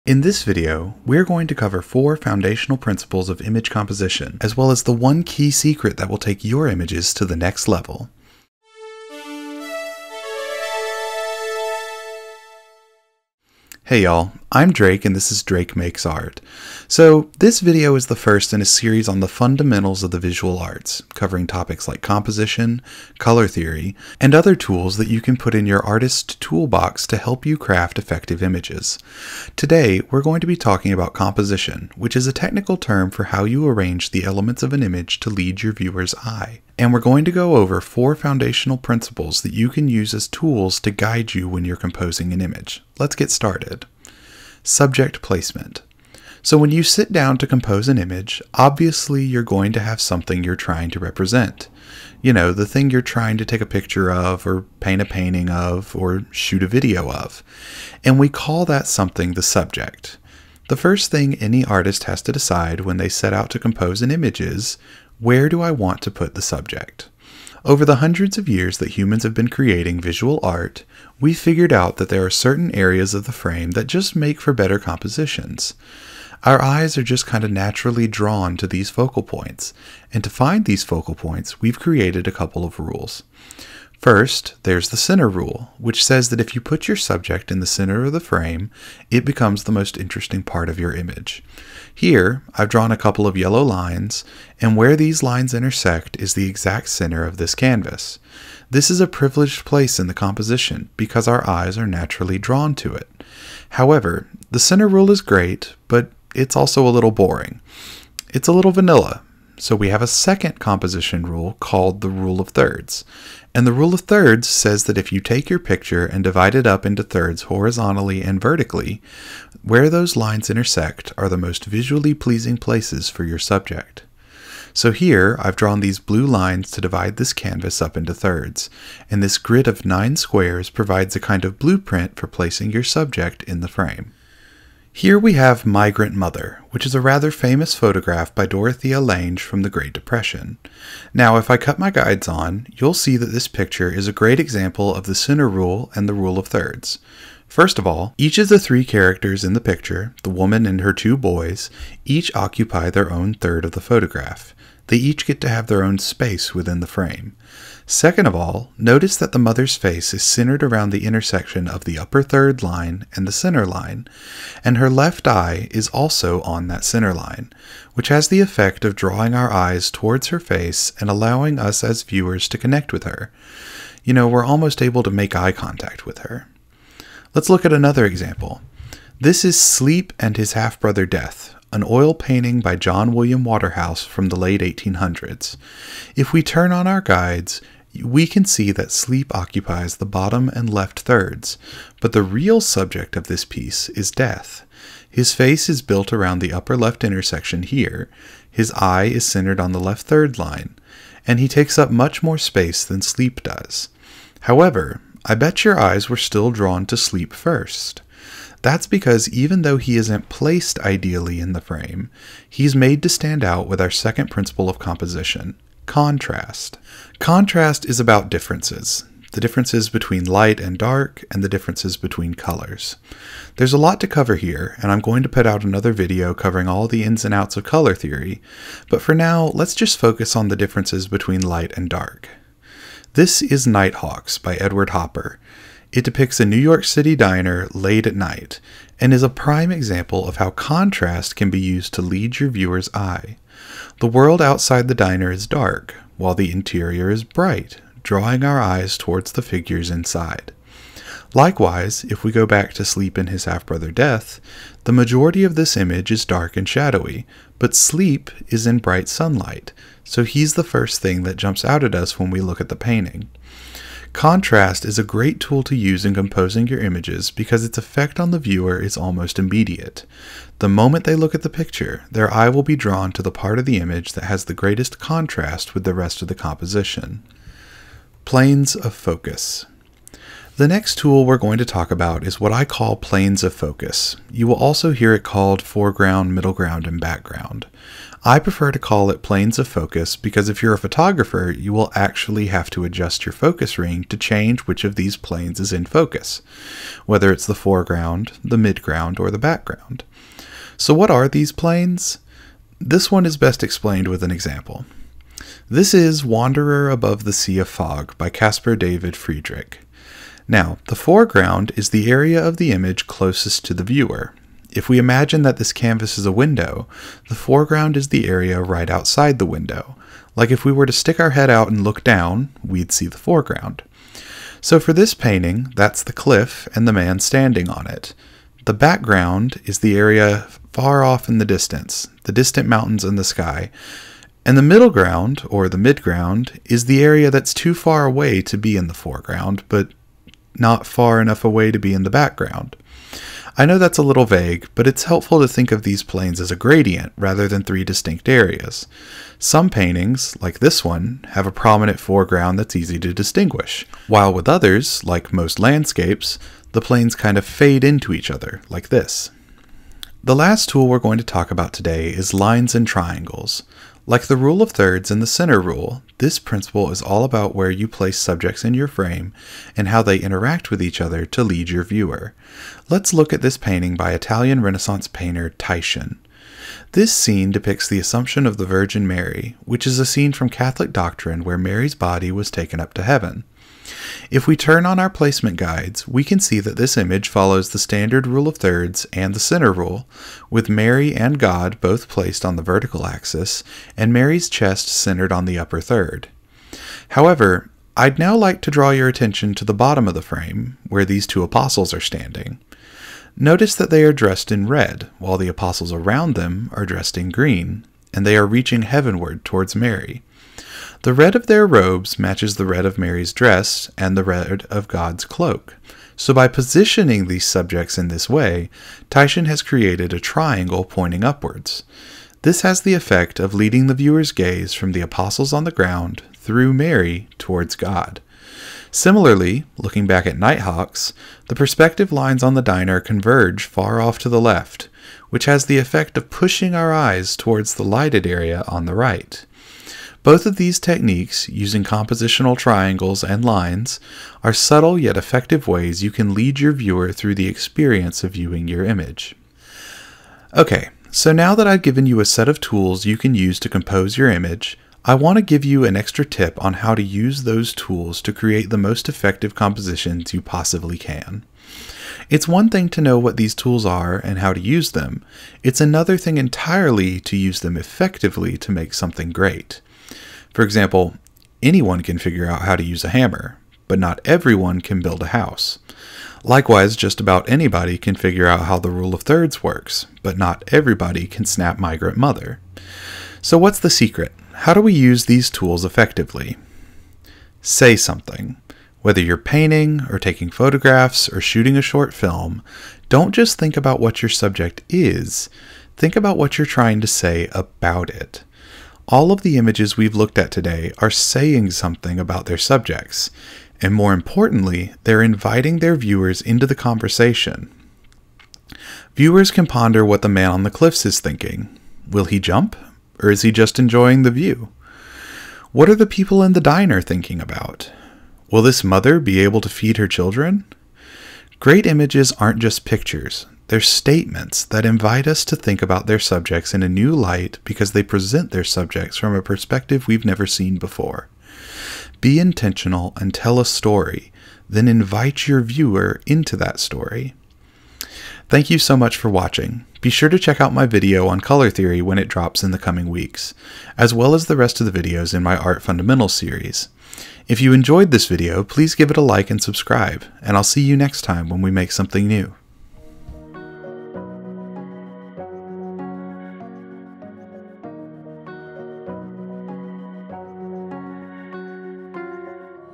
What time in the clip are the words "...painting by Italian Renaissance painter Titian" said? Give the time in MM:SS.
06:13.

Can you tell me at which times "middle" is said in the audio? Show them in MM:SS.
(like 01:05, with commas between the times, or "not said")
04:46, 05:34.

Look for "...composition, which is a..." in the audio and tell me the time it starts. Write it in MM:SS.
00:31.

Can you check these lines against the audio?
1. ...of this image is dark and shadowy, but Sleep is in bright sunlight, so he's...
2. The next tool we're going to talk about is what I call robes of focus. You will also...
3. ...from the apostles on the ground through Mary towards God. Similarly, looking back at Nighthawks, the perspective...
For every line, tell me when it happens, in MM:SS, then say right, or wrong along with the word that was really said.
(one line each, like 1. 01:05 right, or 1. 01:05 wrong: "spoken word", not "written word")
1. 04:15 right
2. 04:40 wrong: "planes", not "robes"
3. 07:04 right.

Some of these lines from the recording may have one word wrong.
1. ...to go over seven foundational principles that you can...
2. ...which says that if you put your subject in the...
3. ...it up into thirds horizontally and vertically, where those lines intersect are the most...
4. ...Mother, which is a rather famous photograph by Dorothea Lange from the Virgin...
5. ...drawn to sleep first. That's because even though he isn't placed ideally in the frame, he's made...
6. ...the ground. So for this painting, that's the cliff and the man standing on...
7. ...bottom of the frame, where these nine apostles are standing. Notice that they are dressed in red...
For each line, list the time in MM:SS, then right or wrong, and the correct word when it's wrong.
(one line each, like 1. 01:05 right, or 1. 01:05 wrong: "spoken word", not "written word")
1. 00:37 wrong: "four", not "seven"
2. 01:25 right
3. 01:56 right
4. 02:16 wrong: "Great", not "Virgin"
5. 03:26 right
6. 05:23 wrong: "foreground", not "ground"
7. 06:39 wrong: "two", not "nine".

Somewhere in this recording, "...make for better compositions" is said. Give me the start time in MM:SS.
01:14.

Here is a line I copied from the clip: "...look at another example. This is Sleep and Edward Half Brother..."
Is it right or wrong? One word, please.
wrong.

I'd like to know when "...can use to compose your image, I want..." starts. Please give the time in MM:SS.
07:33.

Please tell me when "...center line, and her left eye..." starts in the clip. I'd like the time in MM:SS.
02:43.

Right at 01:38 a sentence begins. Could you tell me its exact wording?
This is a privileged place in the composition because our eyes are naturally drawn to it.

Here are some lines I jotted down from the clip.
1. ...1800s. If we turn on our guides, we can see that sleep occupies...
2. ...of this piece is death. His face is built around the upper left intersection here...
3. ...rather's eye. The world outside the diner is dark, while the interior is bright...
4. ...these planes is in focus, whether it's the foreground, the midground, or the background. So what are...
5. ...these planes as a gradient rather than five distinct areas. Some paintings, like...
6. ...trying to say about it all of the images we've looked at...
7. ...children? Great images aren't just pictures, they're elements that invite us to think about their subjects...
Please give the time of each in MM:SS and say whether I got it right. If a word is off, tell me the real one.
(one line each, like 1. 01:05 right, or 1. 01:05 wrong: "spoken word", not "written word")
1. 03:04 right
2. 03:13 right
3. 04:02 wrong: "viewer", not "rather"
4. 04:54 right
5. 05:45 wrong: "three", not "five"
6. 08:16 right
7. 08:40 wrong: "statements", not "elements".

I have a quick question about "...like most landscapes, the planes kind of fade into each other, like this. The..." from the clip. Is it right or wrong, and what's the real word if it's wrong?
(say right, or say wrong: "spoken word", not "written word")
right.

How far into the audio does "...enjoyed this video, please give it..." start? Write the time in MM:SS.
09:07.